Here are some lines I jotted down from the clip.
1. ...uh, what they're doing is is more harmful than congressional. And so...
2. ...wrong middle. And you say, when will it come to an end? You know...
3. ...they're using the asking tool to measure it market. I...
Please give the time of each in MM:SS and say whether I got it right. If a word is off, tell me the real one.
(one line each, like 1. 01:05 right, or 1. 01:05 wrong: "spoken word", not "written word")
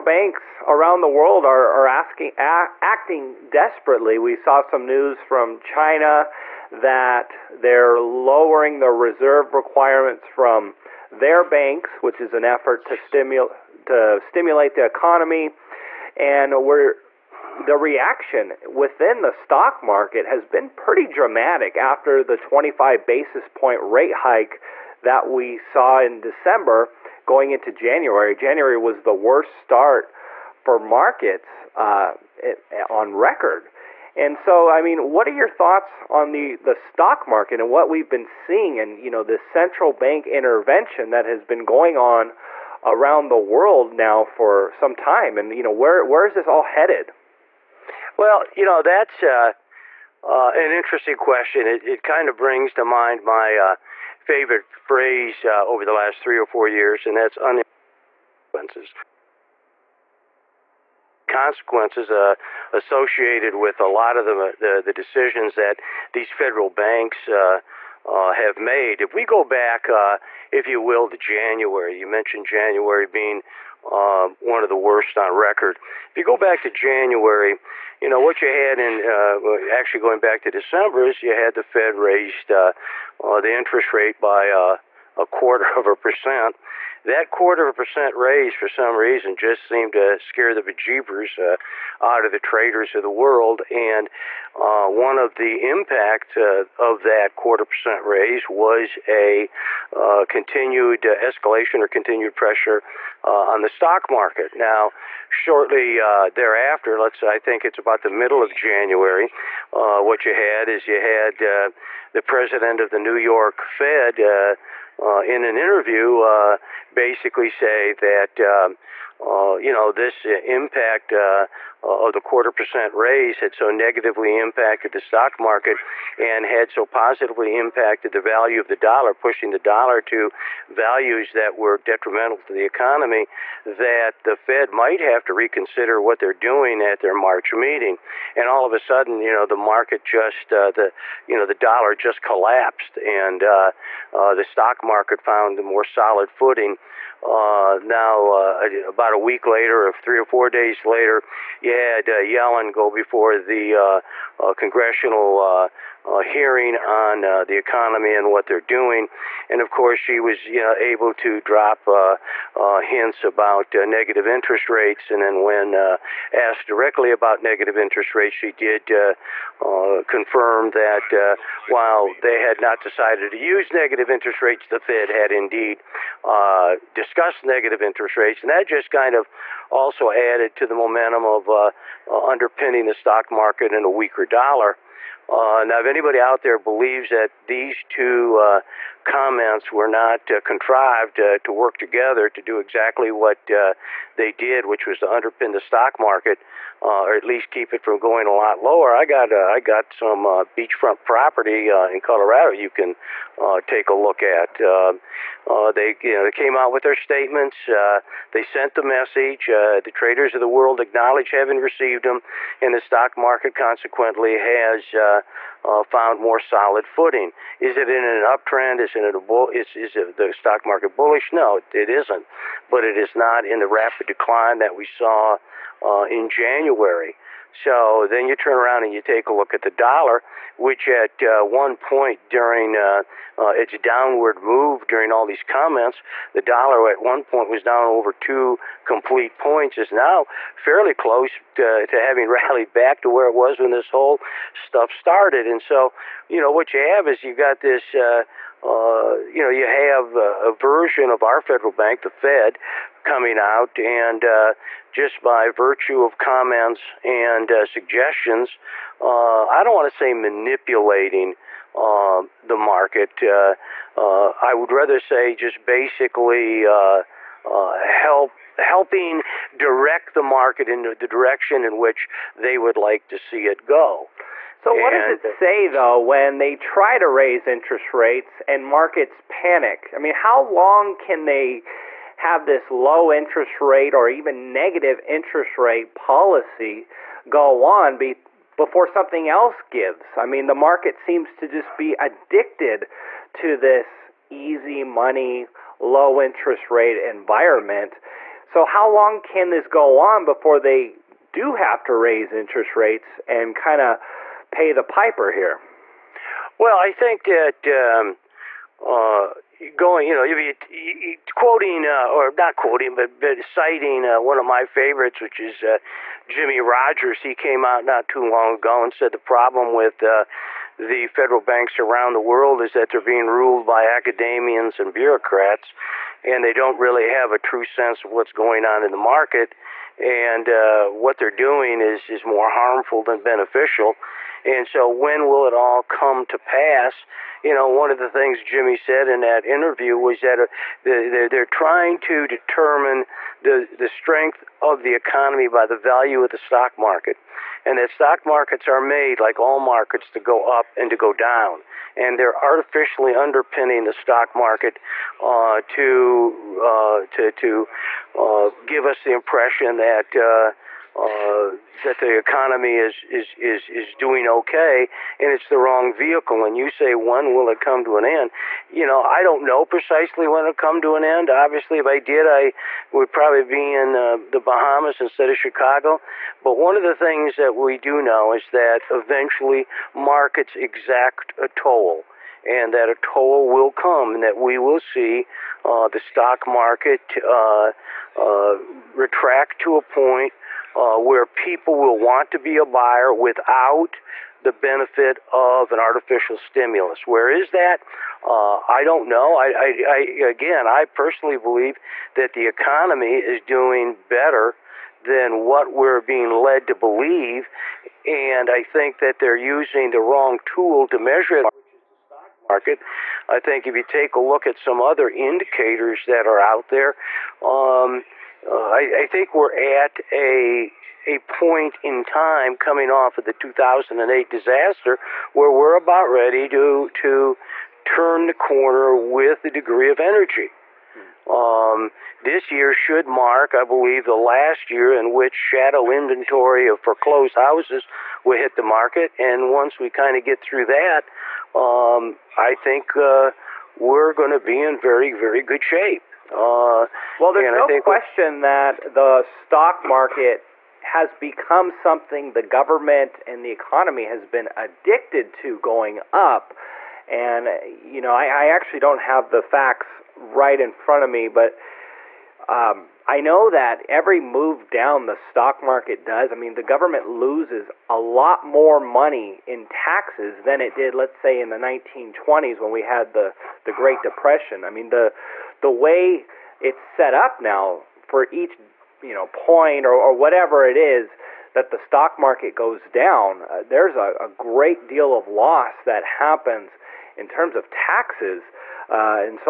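1. 05:30 wrong: "beneficial", not "congressional"
2. 06:05 wrong: "vehicle", not "middle"
3. 06:49 wrong: "wrong", not "asking".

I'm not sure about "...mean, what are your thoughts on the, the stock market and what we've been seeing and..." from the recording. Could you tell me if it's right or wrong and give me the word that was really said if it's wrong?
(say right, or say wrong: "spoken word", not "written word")
right.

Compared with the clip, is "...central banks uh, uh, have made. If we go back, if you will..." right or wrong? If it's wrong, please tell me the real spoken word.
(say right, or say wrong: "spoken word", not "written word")
wrong: "federal", not "central".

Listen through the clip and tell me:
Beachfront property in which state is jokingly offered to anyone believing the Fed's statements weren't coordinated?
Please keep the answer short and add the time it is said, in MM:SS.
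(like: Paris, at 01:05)
Colorado, at 03:22.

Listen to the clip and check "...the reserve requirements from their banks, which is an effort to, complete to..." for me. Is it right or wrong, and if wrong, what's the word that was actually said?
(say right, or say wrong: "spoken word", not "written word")
wrong: "stimulate", not "complete".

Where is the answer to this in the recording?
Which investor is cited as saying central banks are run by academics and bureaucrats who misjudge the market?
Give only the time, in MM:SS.
05:16.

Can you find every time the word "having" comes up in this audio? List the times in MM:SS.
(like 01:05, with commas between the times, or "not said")
03:31, 04:02.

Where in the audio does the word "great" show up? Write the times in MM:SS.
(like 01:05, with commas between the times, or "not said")
07:53, 08:04.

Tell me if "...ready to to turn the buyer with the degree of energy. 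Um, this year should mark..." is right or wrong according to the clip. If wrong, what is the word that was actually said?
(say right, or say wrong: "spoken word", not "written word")
wrong: "corner", not "buyer".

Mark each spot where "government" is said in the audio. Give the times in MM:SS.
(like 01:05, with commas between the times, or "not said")
07:32, 07:46.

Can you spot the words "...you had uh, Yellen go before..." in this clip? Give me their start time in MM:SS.
02:31.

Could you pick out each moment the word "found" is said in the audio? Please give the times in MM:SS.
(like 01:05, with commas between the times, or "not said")
02:25, 03:35.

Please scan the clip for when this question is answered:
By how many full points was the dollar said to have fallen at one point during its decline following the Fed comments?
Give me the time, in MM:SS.
03:58.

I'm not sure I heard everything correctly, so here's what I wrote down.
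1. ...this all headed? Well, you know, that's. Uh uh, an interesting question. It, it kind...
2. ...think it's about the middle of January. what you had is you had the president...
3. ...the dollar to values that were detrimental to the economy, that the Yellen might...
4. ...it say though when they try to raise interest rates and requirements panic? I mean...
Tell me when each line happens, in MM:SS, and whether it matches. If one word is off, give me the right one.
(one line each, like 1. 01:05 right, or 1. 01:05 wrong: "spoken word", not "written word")
1. 00:46 right
2. 01:47 right
3. 02:09 wrong: "Fed", not "Yellen"
4. 04:35 wrong: "markets", not "requirements".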